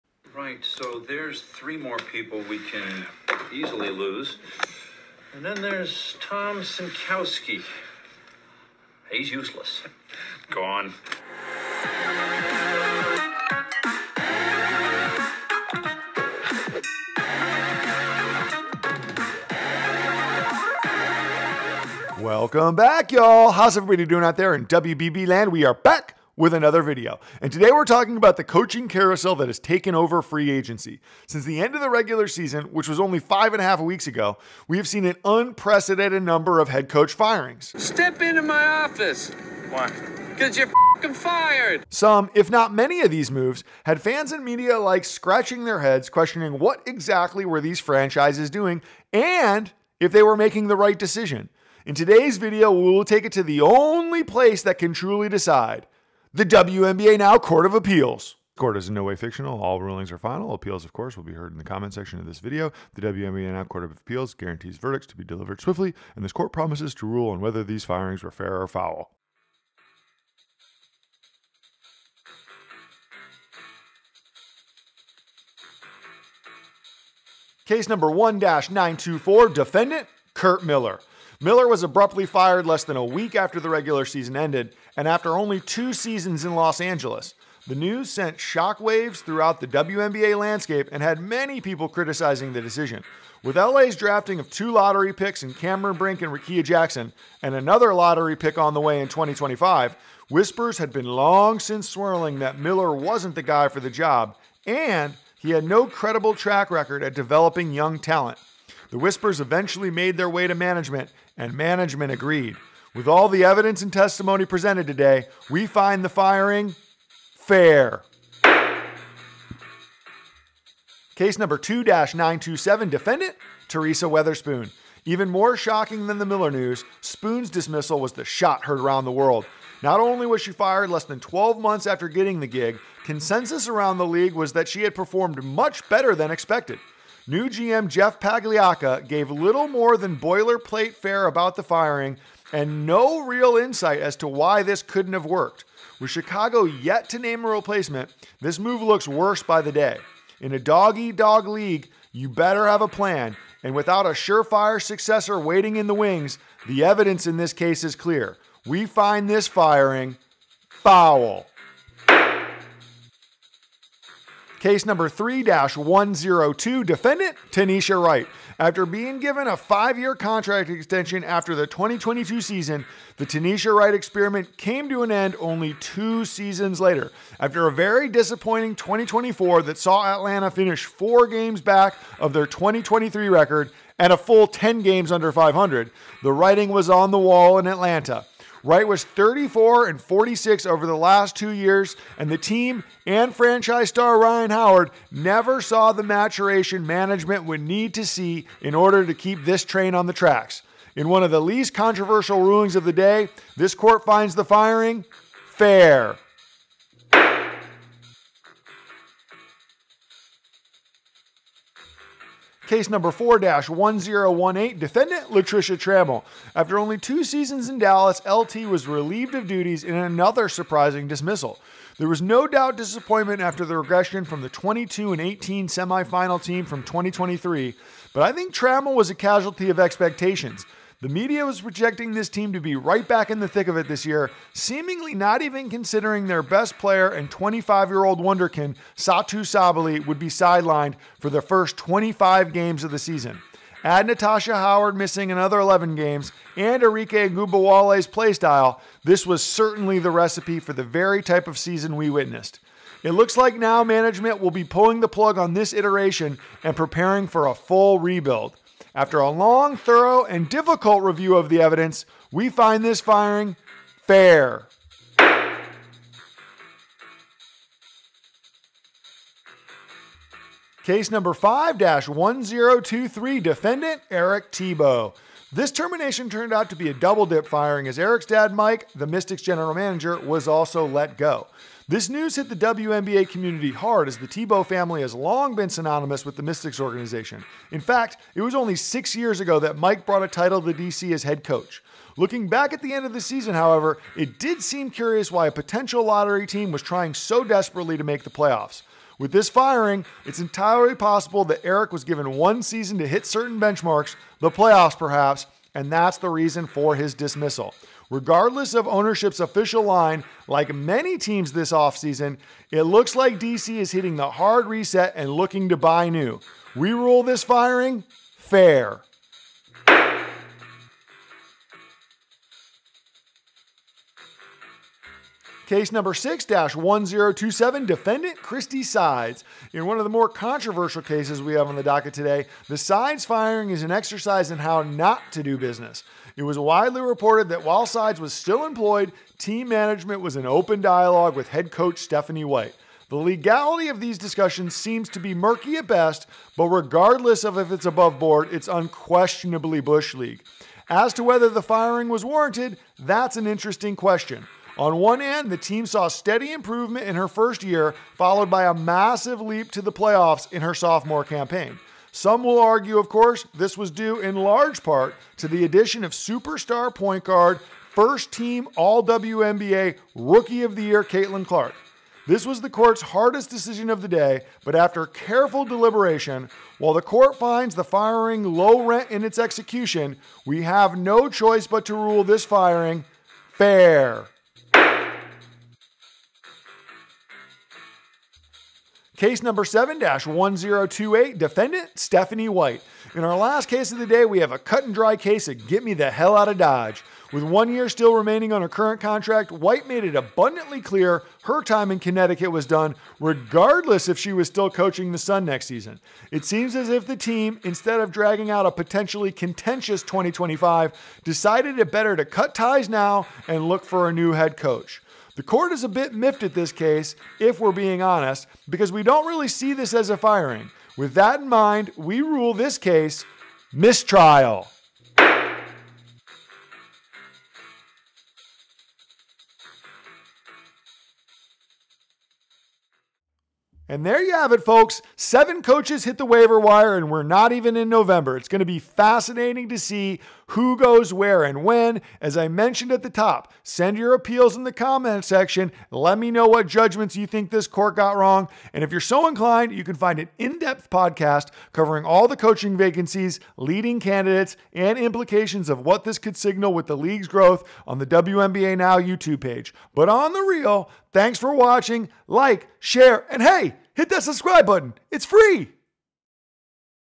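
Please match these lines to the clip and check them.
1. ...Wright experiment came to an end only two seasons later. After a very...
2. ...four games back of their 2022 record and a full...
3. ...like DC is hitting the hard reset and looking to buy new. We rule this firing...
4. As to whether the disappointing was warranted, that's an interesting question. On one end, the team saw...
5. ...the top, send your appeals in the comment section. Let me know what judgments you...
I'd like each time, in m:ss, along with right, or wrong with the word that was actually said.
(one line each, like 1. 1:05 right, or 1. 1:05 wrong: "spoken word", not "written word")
1. 2:53 right
2. 3:00 wrong: "2023", not "2022"
3. 5:13 right
4. 5:50 wrong: "firing", not "disappointing"
5. 7:23 right.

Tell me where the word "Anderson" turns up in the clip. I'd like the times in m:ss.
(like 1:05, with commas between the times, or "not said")
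not said.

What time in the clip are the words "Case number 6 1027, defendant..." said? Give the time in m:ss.
5:25.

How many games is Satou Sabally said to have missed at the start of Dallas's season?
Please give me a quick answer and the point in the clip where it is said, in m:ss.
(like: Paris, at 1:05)
25, at 4:01.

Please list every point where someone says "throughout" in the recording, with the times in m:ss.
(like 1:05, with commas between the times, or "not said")
1:29.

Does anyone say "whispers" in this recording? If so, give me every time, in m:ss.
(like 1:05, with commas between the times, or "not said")
1:40, 1:48.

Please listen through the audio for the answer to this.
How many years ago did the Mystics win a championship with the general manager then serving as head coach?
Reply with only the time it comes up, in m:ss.
4:48.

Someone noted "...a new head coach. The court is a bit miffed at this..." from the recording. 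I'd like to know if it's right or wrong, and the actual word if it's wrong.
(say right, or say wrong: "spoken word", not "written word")
right.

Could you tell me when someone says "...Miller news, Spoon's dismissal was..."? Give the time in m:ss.
2:06.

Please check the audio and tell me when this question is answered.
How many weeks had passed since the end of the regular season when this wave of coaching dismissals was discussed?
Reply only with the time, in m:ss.
0:33.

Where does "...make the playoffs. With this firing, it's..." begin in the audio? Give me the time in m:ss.
4:58.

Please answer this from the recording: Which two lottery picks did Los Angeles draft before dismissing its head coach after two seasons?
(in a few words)
Cameron Brink and Rickea Jackson.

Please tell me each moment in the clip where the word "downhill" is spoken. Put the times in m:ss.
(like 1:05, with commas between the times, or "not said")
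not said.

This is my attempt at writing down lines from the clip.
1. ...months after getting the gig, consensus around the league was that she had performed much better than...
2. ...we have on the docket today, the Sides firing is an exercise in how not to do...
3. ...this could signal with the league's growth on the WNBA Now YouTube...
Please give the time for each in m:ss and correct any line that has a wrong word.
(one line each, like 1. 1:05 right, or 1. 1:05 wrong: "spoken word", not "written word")
1. 2:11 right
2. 5:31 right
3. 7:36 right.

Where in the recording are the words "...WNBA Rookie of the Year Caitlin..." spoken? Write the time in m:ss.
6:09.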